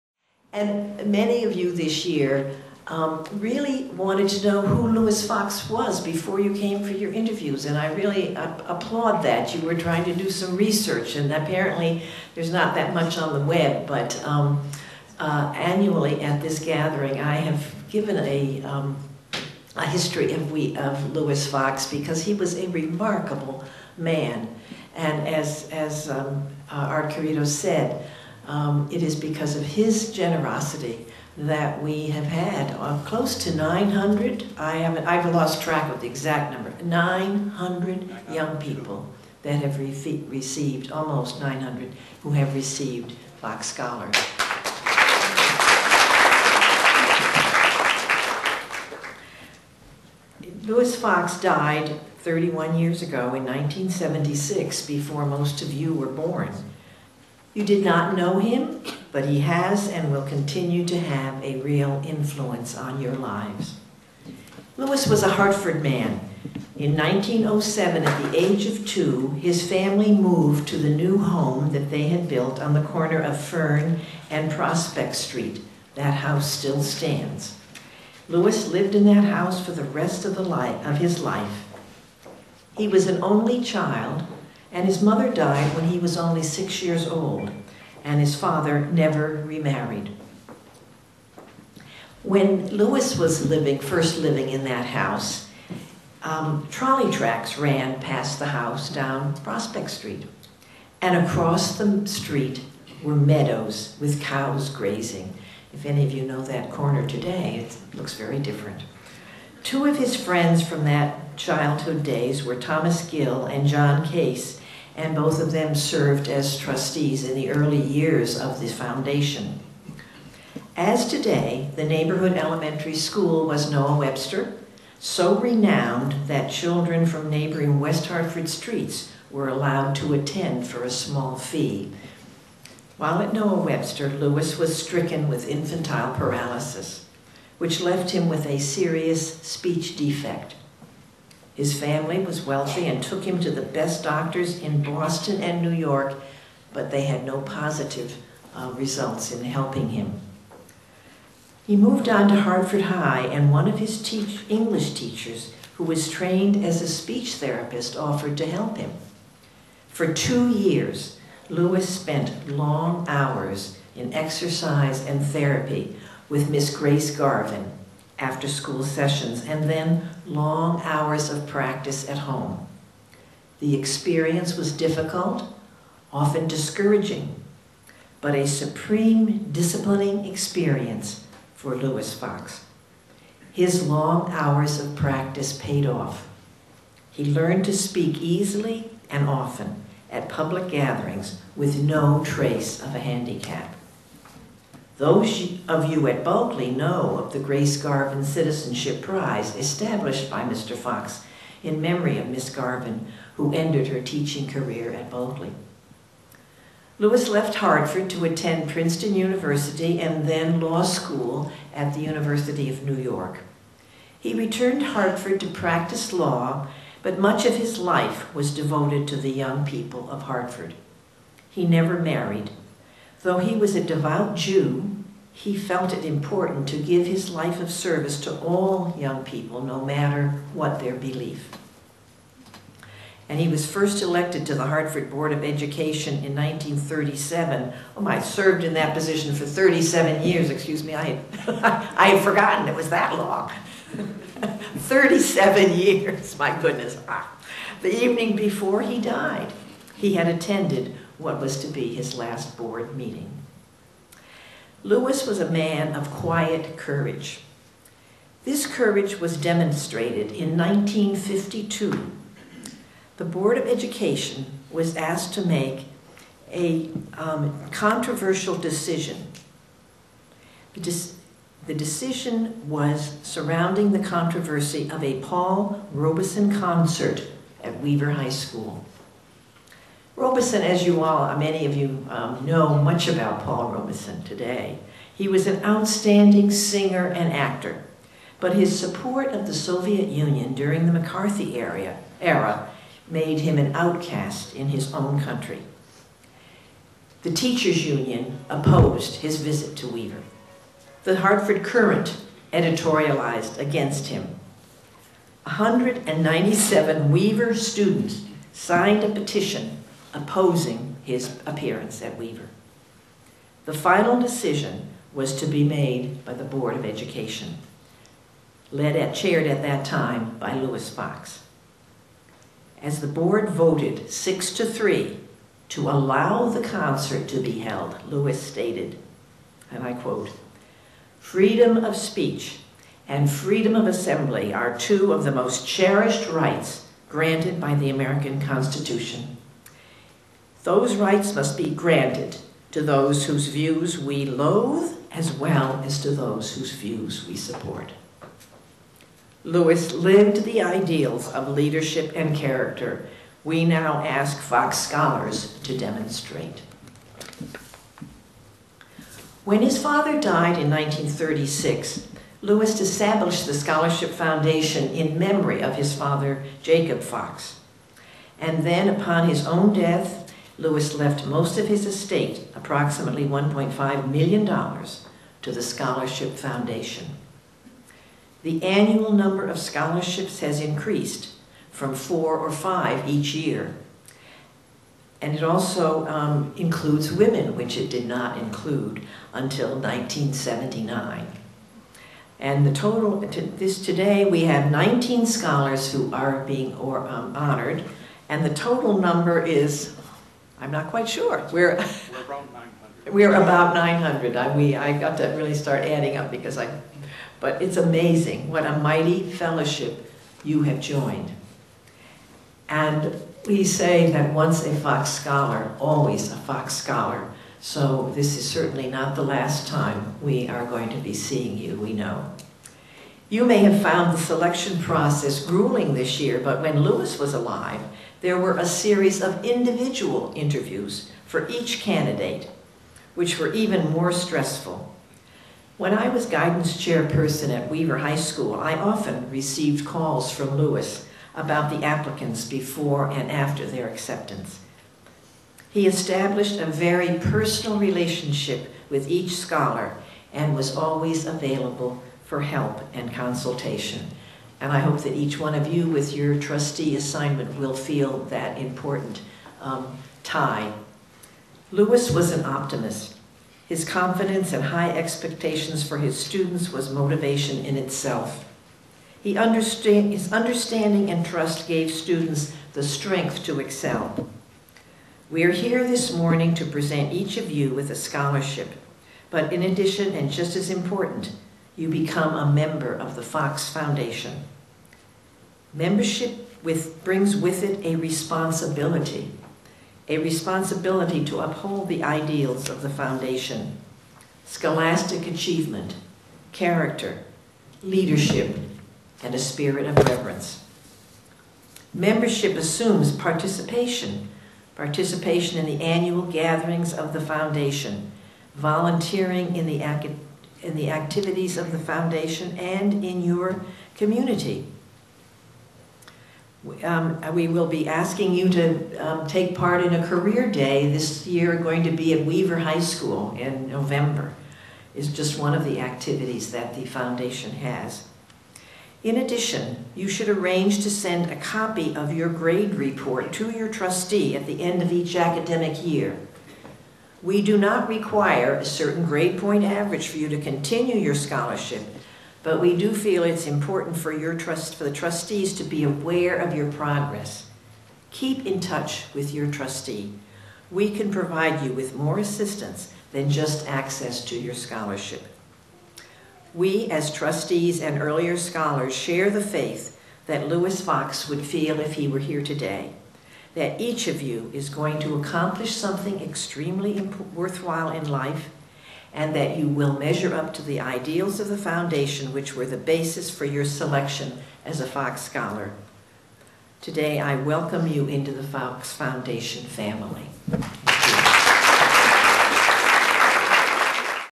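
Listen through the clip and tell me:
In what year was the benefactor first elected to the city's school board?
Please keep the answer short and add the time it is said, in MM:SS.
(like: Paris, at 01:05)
1937, at 03:56.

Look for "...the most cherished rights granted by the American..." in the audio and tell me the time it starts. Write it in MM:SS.
05:35.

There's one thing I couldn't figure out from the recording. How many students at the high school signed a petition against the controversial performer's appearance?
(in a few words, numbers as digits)
197.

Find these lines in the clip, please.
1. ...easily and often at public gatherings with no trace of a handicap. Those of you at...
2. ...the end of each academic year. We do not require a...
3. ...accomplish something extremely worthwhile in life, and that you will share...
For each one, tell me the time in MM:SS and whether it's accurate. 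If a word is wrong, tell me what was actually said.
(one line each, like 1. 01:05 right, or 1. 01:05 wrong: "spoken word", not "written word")
1. 03:08 right
2. 08:54 right
3. 09:25 wrong: "measure", not "share".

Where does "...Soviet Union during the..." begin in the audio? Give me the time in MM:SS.
04:49.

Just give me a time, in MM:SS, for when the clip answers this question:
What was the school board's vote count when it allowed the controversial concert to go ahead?
05:24.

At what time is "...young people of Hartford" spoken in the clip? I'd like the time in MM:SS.
03:39.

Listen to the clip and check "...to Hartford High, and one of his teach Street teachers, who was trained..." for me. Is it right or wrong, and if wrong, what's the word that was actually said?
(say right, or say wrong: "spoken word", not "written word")
wrong: "English", not "Street".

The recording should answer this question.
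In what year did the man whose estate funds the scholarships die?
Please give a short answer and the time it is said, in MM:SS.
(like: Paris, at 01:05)
1976, at 00:53.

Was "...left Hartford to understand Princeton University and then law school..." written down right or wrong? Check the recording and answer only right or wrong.
wrong.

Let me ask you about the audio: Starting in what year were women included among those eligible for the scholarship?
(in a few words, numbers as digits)
1979.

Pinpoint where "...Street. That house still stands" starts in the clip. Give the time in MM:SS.
01:15.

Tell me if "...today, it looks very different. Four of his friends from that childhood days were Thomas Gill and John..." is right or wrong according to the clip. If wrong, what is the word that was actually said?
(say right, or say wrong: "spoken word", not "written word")
wrong: "Two", not "Four".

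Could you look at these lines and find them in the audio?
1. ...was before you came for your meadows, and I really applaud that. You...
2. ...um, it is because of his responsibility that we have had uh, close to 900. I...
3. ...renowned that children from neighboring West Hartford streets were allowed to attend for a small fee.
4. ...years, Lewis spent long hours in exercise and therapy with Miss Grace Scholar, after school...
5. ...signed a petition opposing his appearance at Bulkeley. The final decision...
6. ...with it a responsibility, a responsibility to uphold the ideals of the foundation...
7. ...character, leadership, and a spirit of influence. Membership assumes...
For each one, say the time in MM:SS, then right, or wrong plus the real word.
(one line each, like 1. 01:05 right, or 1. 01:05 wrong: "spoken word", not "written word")
1. 00:05 wrong: "interviews", not "meadows"
2. 00:28 wrong: "generosity", not "responsibility"
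3. 02:05 right
4. 02:40 wrong: "Garvin", not "Scholar"
5. 05:08 wrong: "Weaver", not "Bulkeley"
6. 08:07 right
7. 08:16 wrong: "reverence", not "influence".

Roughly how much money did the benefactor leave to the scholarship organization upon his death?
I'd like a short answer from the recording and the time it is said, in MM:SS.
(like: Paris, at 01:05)
$1.5 million, at 06:13.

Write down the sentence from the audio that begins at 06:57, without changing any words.
So this is certainly not the last time we are going to be seeing you, we know.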